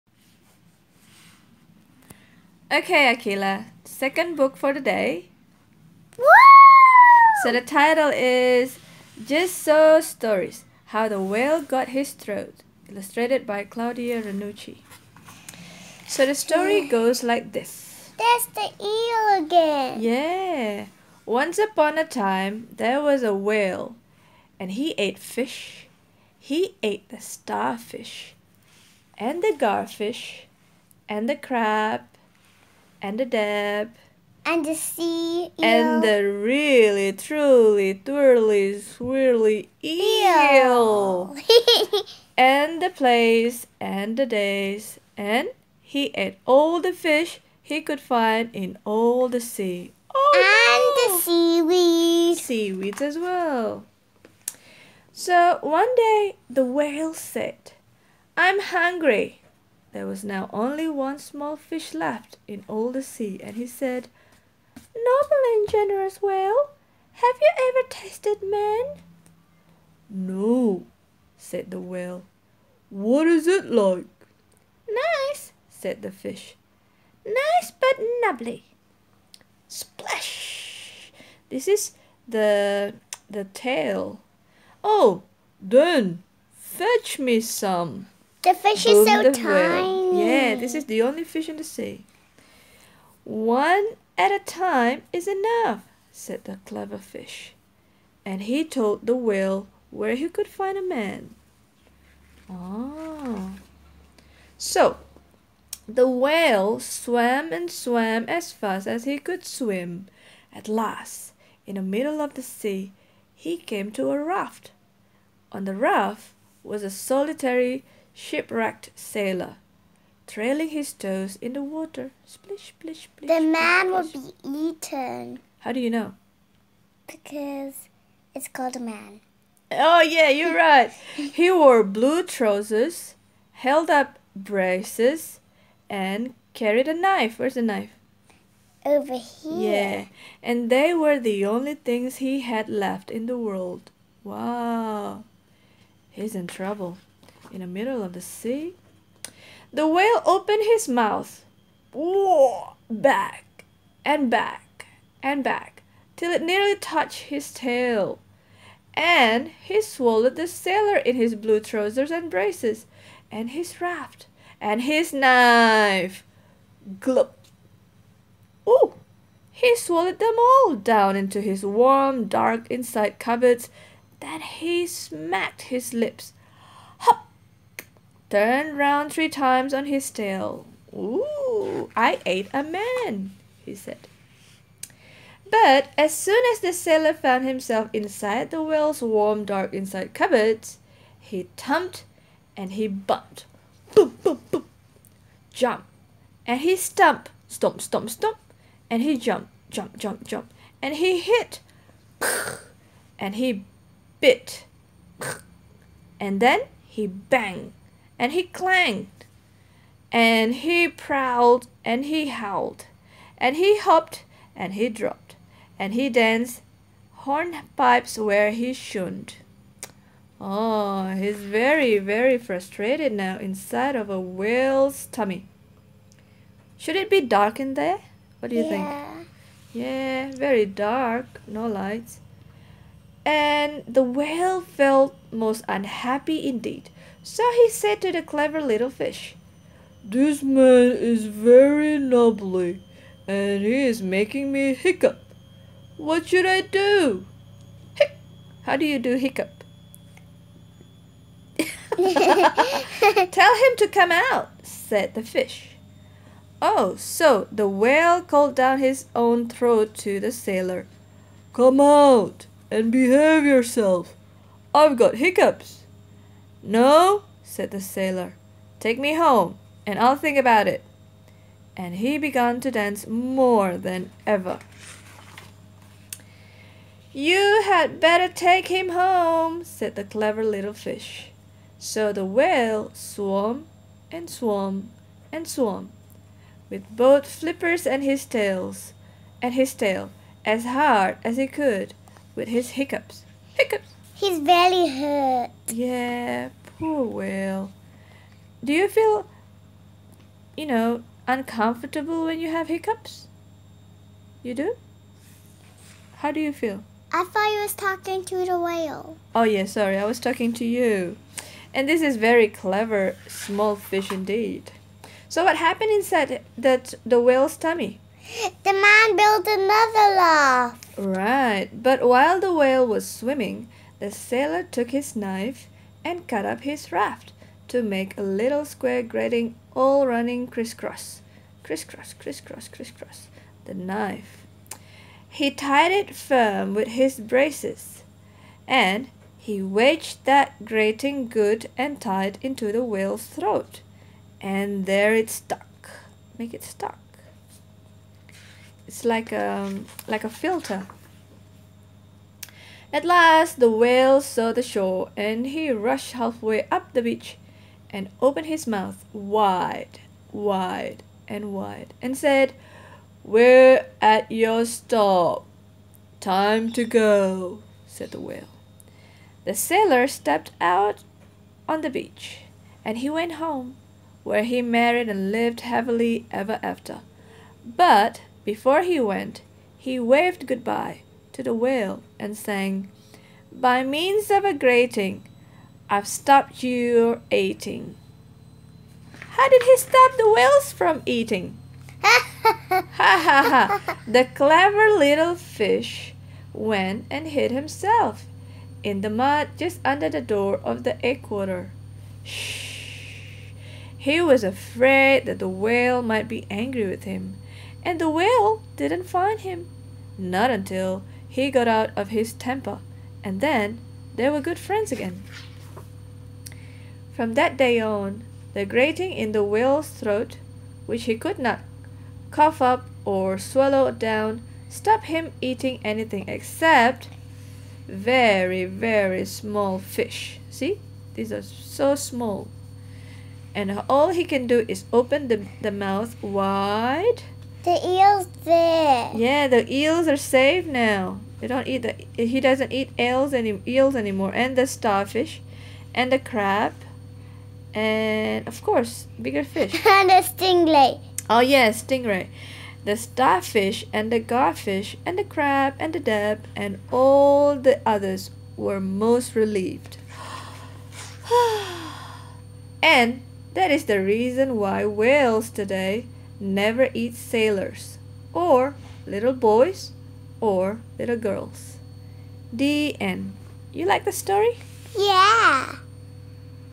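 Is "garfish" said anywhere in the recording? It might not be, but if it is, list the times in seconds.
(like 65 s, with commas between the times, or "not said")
29 s, 454 s.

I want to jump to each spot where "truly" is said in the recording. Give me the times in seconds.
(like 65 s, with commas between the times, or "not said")
37 s.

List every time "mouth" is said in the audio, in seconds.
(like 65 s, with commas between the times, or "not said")
150 s, 358 s, 435 s.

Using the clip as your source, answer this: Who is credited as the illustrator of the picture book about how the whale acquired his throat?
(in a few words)
Claudia Ranucci.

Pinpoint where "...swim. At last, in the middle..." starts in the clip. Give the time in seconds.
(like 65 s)
109 s.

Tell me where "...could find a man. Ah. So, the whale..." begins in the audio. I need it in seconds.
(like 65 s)
100 s.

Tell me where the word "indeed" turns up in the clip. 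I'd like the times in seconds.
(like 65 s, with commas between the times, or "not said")
236 s, 314 s.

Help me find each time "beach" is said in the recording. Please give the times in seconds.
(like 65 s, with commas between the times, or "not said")
357 s, 371 s.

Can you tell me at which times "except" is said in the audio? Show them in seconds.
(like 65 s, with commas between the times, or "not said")
426 s.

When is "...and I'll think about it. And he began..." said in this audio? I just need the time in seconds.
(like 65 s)
269 s.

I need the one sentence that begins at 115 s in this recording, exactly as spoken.
On the raft was a solitary Shipwrecked sailor, trailing his toes in the water.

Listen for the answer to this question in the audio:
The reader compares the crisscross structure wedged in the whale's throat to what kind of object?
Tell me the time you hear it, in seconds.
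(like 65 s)
350 s.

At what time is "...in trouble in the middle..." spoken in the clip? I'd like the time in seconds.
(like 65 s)
146 s.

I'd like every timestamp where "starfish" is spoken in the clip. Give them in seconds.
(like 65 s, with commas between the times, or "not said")
27 s, 444 s, 452 s.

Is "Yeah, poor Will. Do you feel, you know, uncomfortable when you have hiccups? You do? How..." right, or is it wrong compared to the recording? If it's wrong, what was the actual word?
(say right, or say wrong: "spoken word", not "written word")
right.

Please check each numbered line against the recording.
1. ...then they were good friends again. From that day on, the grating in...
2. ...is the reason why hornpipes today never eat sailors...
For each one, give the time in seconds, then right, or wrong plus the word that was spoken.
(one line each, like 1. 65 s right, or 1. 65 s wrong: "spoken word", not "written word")
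1. 413 s right
2. 463 s wrong: "whales", not "hornpipes".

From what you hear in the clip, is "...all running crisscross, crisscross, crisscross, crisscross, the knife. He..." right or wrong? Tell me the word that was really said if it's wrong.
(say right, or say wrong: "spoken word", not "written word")
right.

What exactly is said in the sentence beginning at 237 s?
So he said to the clever little fish, This man is very nubbly, and he is making me hiccup.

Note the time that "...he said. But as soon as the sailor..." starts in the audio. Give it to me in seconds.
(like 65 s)
183 s.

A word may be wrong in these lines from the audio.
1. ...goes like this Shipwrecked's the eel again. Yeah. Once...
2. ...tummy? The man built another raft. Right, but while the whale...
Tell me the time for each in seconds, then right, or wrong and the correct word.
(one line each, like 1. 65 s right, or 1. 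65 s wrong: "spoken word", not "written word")
1. 16 s wrong: "That", not "Shipwrecked"
2. 317 s right.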